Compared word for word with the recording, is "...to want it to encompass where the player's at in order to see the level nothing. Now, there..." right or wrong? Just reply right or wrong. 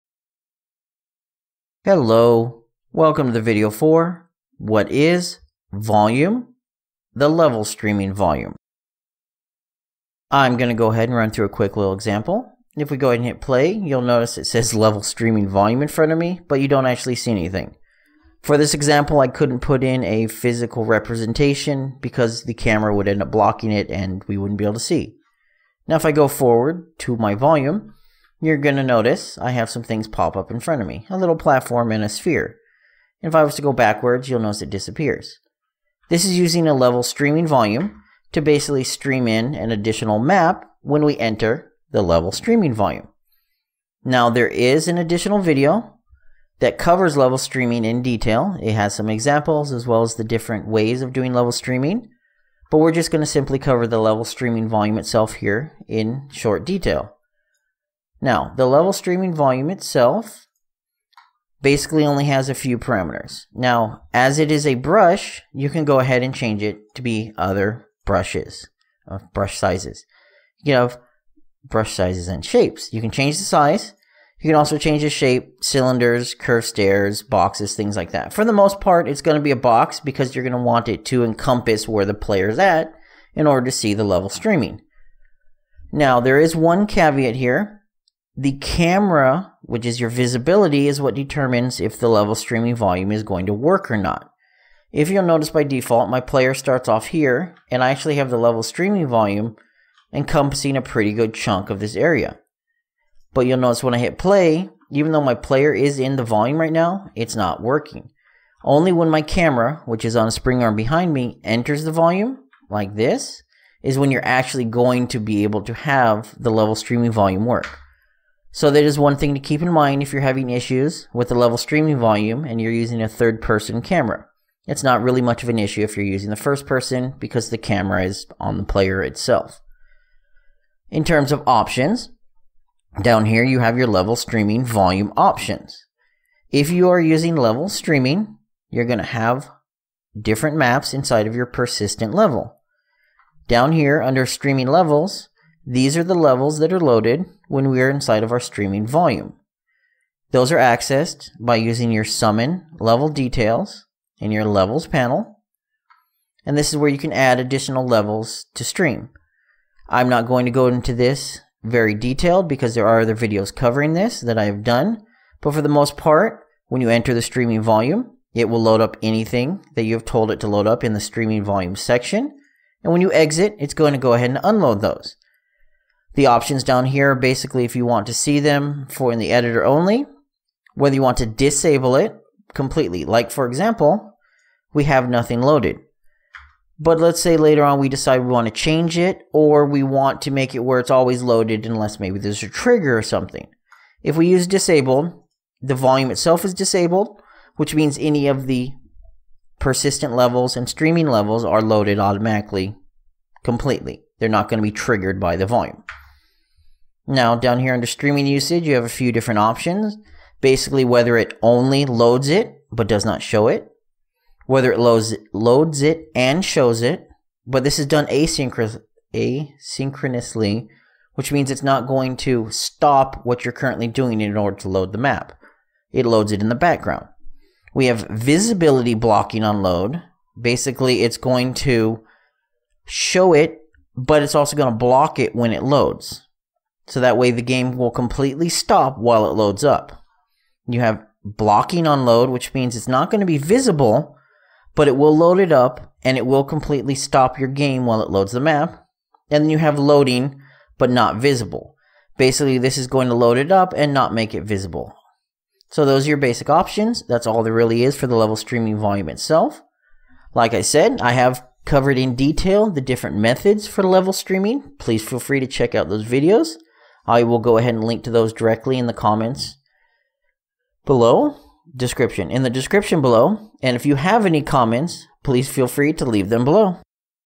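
wrong.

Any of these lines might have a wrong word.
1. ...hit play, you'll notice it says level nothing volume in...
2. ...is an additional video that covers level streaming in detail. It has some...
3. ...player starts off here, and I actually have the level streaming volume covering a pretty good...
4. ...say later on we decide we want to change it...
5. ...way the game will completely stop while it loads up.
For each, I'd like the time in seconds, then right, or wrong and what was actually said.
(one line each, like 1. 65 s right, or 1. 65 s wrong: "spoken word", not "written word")
1. 13 s wrong: "streaming", not "nothing"
2. 44 s right
3. 96 s wrong: "encompassing", not "covering"
4. 187 s right
5. 237 s right.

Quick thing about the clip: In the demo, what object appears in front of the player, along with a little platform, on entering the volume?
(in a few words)
a sphere.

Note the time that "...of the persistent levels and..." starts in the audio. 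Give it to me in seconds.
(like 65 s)
198 s.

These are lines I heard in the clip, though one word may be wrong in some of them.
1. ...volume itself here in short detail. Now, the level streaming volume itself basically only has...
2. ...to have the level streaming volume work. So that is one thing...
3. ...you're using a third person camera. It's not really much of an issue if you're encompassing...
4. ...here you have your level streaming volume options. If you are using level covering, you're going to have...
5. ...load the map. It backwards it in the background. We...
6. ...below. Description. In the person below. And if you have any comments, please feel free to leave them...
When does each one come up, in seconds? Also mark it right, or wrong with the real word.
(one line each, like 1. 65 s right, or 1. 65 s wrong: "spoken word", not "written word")
1. 54 s right
2. 115 s right
3. 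122 s wrong: "using", not "encompassing"
4. 133 s wrong: "streaming", not "covering"
5. 224 s wrong: "loads", not "backwards"
6. 270 s wrong: "description", not "person".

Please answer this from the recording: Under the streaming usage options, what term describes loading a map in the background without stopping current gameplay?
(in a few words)
asynchronously.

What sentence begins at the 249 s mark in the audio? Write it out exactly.
And then you have loading, but not visible.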